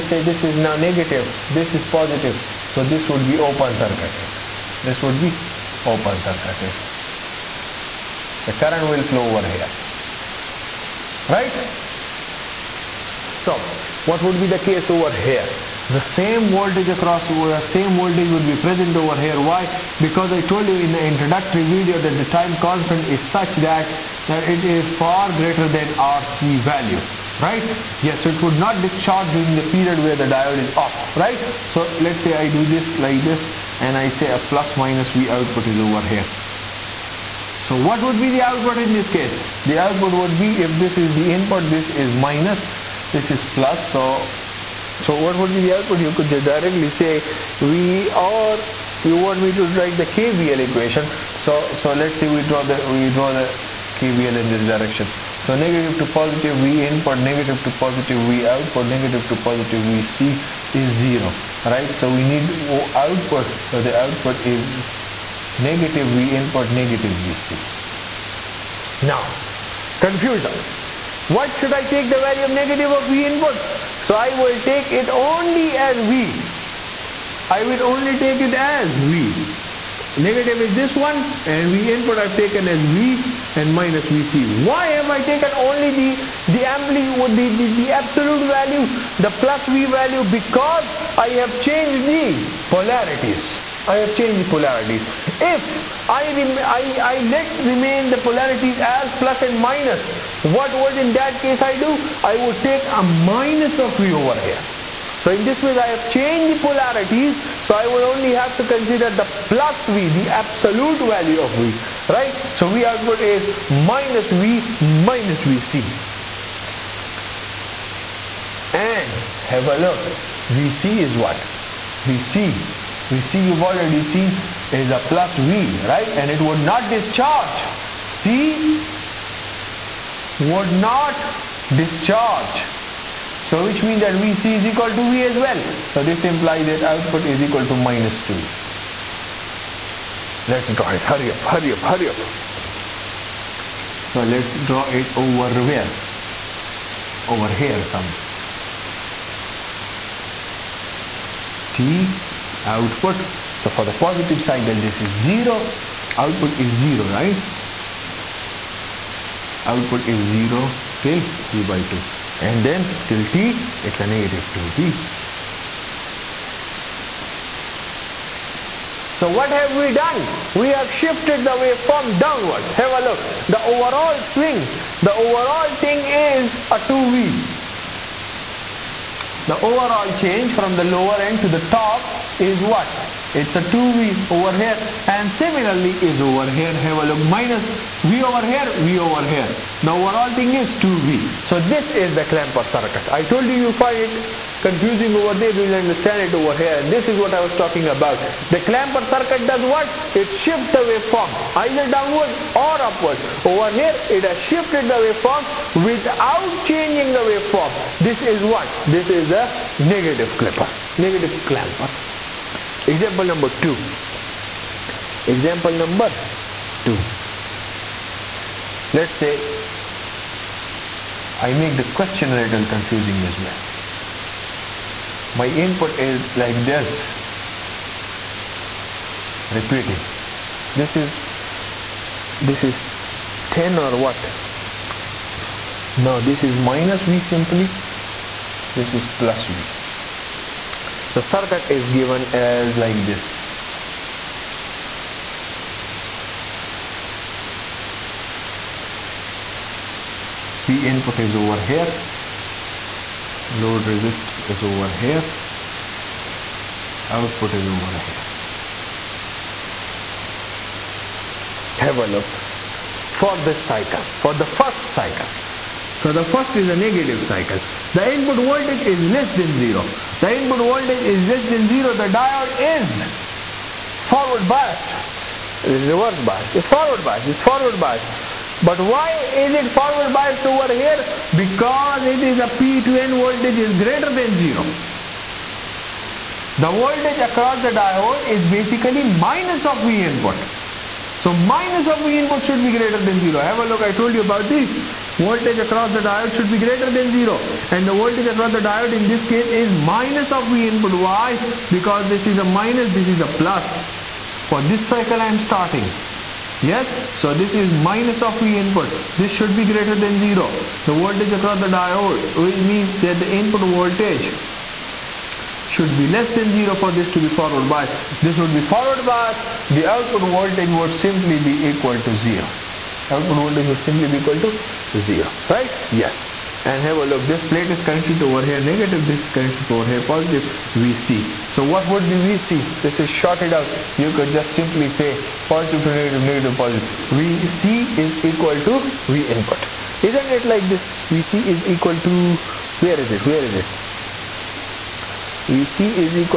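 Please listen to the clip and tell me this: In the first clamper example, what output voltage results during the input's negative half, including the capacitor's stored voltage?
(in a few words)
-2V.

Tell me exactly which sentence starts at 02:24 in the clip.
So let's draw it over where?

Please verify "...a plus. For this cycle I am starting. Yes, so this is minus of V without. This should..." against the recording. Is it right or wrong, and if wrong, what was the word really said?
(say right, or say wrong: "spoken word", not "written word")
wrong: "input", not "without".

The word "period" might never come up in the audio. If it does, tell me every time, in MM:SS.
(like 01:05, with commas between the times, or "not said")
00:29.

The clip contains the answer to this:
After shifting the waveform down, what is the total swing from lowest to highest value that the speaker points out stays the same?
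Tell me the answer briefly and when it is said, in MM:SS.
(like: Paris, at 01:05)
2V, at 02:53.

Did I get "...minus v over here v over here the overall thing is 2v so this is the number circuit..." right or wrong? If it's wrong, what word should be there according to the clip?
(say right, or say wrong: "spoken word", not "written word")
wrong: "clamper", not "number".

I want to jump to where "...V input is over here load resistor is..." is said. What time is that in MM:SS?
04:10.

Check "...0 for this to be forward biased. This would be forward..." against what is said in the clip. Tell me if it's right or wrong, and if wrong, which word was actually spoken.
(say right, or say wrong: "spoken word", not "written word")
right.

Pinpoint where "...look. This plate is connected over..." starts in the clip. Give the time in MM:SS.
05:27.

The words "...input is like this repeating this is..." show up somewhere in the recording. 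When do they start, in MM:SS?
03:45.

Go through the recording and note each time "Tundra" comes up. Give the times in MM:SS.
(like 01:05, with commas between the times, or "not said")
not said.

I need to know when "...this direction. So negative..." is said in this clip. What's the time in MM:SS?
00:54.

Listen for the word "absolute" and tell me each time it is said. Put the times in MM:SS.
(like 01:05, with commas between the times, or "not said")
01:27, 01:50.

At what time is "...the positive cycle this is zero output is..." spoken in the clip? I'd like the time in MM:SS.
02:33.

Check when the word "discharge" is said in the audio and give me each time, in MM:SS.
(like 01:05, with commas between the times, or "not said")
00:28, 02:06, 02:11.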